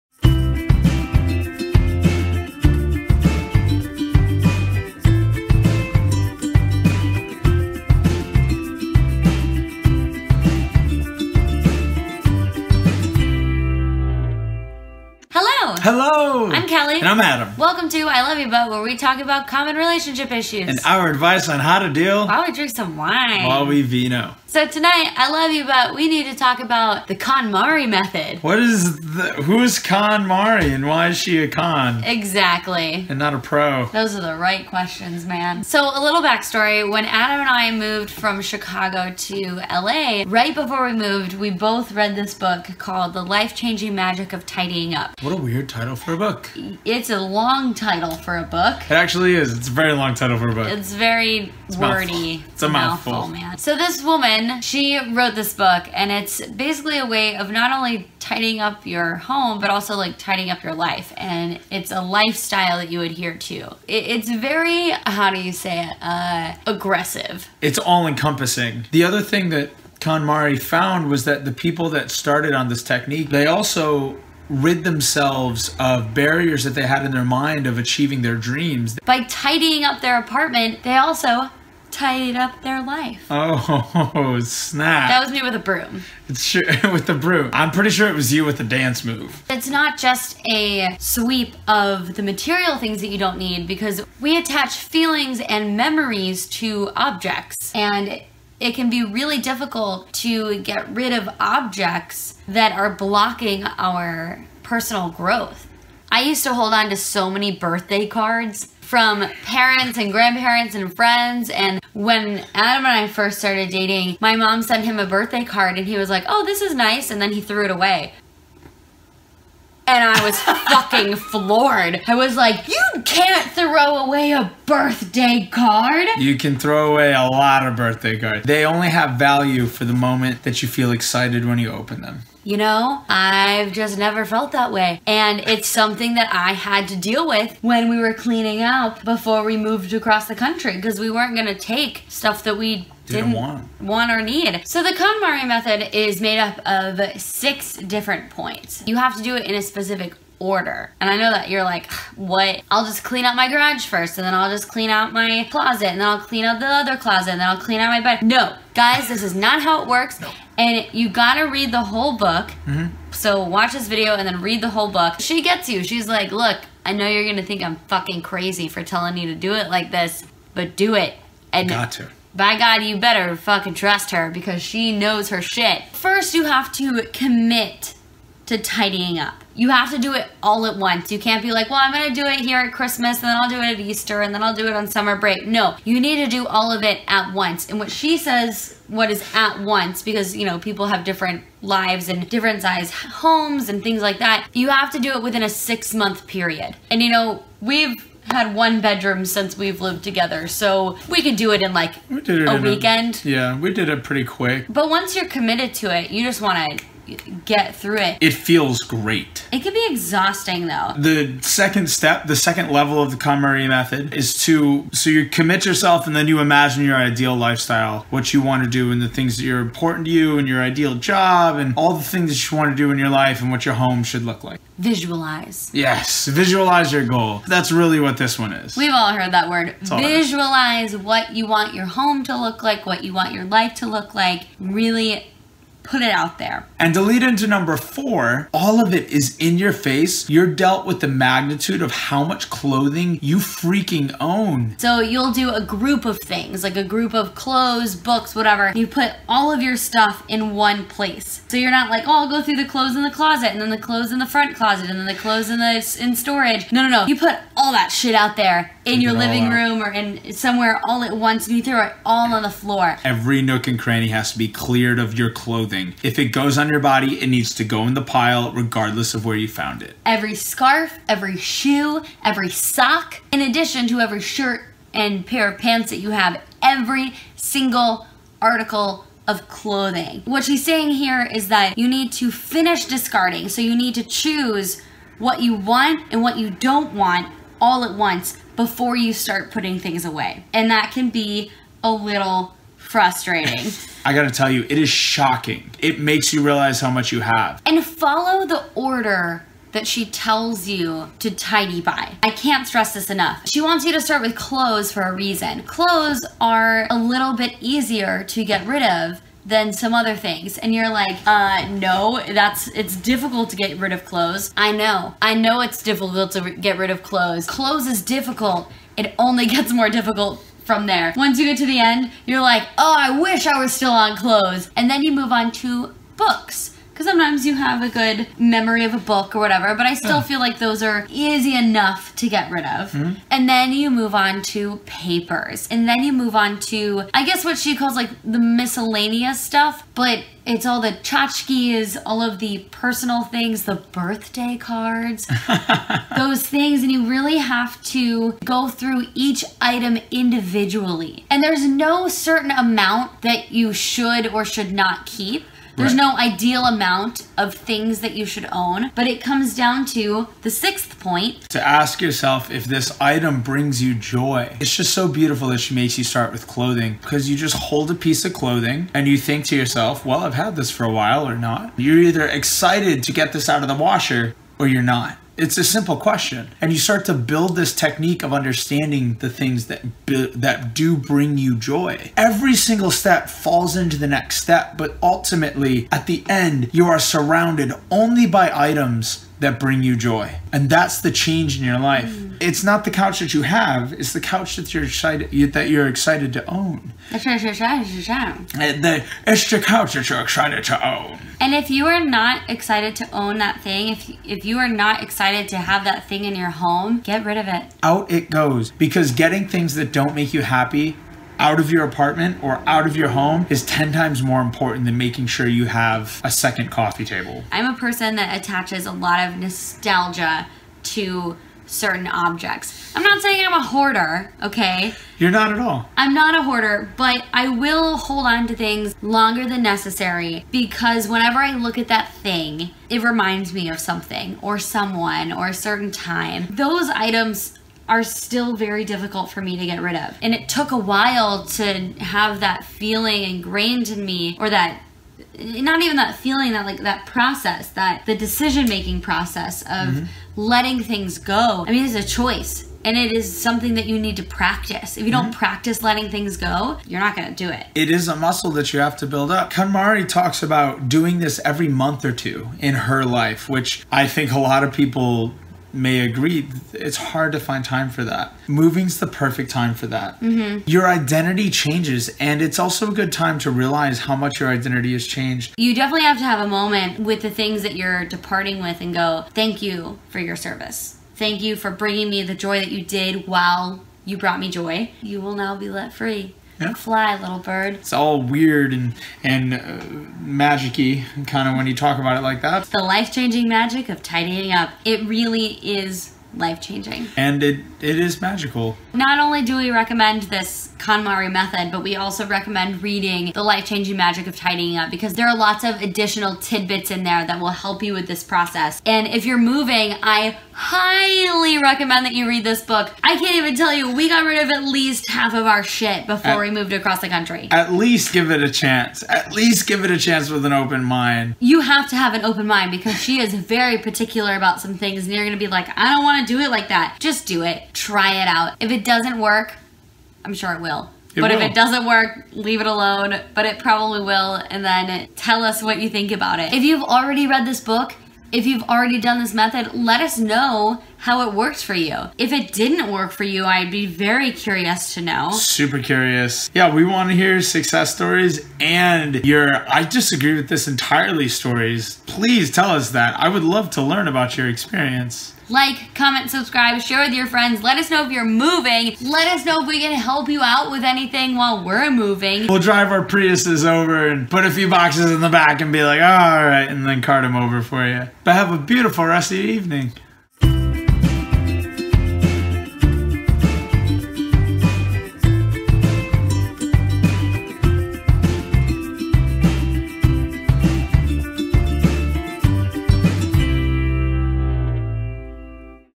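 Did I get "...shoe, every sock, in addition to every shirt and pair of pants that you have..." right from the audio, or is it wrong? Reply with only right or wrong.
right.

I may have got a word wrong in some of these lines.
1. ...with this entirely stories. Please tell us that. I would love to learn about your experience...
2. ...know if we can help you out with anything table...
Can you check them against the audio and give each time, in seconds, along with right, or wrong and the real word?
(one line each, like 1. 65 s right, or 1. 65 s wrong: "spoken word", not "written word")
1. 550 s right
2. 559 s wrong: "while", not "table".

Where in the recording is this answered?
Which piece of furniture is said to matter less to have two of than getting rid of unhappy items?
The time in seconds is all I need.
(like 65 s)
416 s.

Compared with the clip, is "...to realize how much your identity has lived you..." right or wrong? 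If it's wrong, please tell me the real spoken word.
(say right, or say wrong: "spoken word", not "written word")
wrong: "changed", not "lived".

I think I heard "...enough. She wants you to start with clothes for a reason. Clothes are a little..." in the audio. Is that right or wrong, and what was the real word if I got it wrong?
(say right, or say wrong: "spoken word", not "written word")
right.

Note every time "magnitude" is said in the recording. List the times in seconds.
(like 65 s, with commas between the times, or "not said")
241 s.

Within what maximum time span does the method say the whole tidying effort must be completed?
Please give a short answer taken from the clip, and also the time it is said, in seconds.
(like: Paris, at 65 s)
6 months, at 195 s.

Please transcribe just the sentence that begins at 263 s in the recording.
Every nook and cranny has to be cleared of your clothing.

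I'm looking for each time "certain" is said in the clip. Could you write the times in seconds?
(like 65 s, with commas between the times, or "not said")
352 s, 421 s, 435 s.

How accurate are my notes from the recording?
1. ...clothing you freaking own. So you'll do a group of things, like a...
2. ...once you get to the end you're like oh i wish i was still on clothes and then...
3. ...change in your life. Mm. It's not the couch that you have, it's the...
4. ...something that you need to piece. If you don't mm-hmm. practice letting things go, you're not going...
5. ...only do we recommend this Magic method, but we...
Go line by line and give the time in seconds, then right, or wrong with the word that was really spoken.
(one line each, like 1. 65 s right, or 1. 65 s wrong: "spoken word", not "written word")
1. 242 s right
2. 321 s right
3. 391 s right
4. 453 s wrong: "practice", not "piece"
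5. 499 s wrong: "KonMari", not "Magic".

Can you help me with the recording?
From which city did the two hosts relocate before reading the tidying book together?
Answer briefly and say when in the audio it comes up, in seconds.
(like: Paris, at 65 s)
Chicago, at 38 s.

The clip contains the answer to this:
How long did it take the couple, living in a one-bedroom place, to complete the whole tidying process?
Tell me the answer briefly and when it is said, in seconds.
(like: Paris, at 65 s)
a weekend, at 202 s.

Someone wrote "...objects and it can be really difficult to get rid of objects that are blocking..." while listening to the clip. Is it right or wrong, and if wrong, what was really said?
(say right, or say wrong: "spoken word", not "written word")
right.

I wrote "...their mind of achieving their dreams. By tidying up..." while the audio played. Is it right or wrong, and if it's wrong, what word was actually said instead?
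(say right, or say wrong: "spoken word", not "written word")
right.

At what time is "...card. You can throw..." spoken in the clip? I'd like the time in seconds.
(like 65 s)
125 s.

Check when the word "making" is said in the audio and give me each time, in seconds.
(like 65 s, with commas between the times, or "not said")
414 s, 448 s.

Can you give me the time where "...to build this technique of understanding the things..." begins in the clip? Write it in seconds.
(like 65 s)
377 s.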